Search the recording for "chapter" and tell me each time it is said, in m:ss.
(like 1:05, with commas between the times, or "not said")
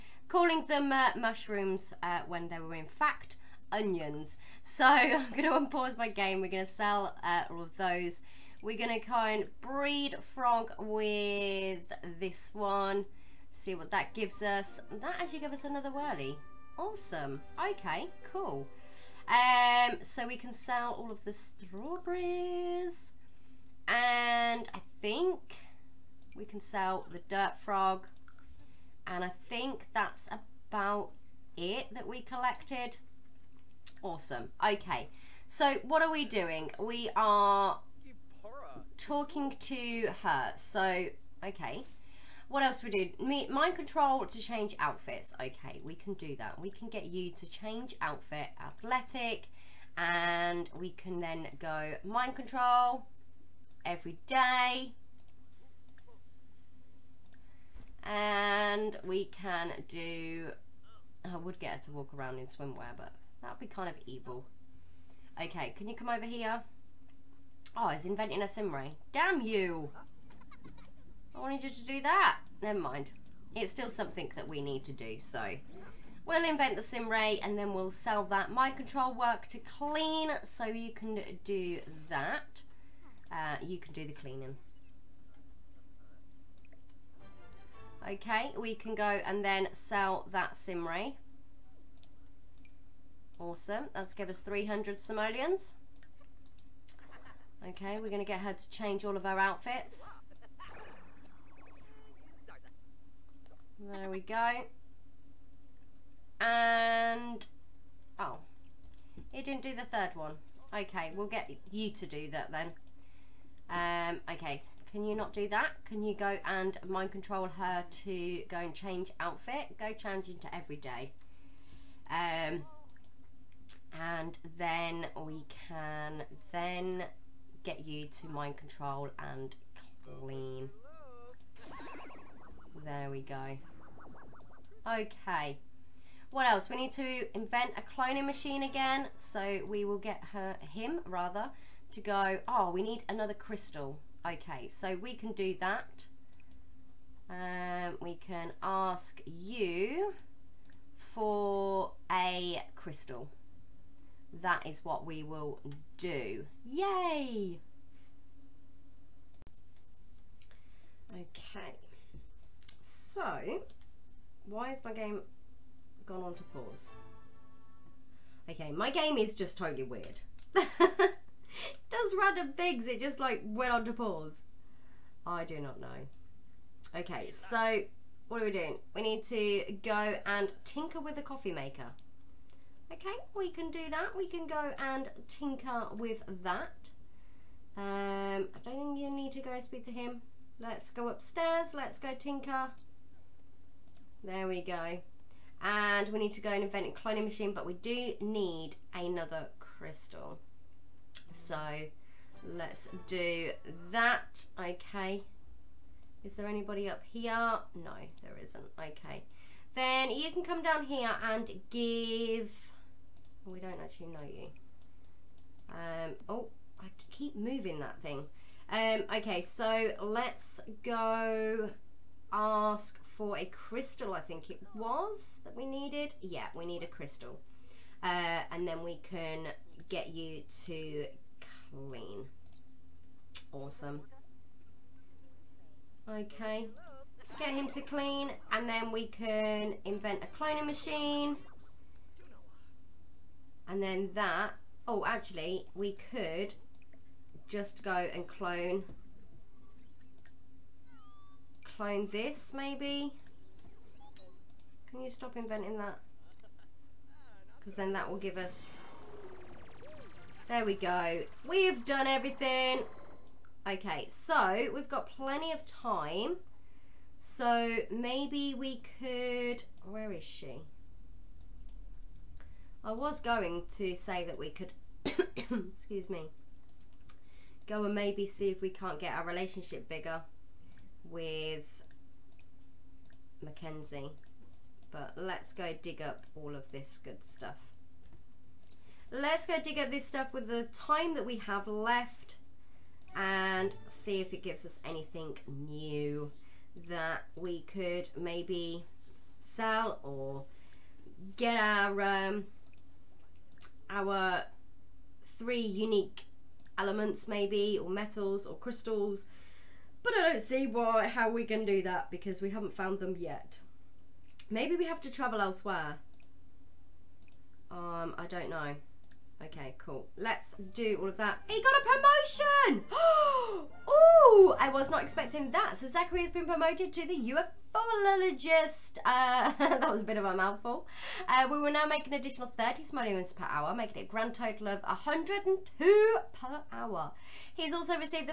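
not said.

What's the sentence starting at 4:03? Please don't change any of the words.
And then that, oh actually we could just go and clone clone this maybe.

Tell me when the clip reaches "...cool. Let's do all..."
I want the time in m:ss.
5:19.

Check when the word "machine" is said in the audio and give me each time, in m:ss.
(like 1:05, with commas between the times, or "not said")
2:18, 3:17, 4:00.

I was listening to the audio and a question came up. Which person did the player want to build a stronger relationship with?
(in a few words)
Mackenzie.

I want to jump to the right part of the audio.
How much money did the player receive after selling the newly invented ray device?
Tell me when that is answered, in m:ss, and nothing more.
1:34.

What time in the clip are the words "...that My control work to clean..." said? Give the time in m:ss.
1:18.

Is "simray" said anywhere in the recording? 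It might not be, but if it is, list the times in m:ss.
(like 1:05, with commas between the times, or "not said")
1:08, 1:16, 1:30.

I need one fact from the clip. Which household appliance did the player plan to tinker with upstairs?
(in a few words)
coffee maker.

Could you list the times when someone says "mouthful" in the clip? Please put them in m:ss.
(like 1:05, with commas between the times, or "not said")
5:30.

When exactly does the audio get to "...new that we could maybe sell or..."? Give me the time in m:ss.
4:55.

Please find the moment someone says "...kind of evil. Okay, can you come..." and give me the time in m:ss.
1:03.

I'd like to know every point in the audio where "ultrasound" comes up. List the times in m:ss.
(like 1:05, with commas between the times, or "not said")
not said.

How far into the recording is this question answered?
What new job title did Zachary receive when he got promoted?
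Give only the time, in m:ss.
5:27.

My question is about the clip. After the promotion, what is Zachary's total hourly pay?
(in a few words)
102 per hour.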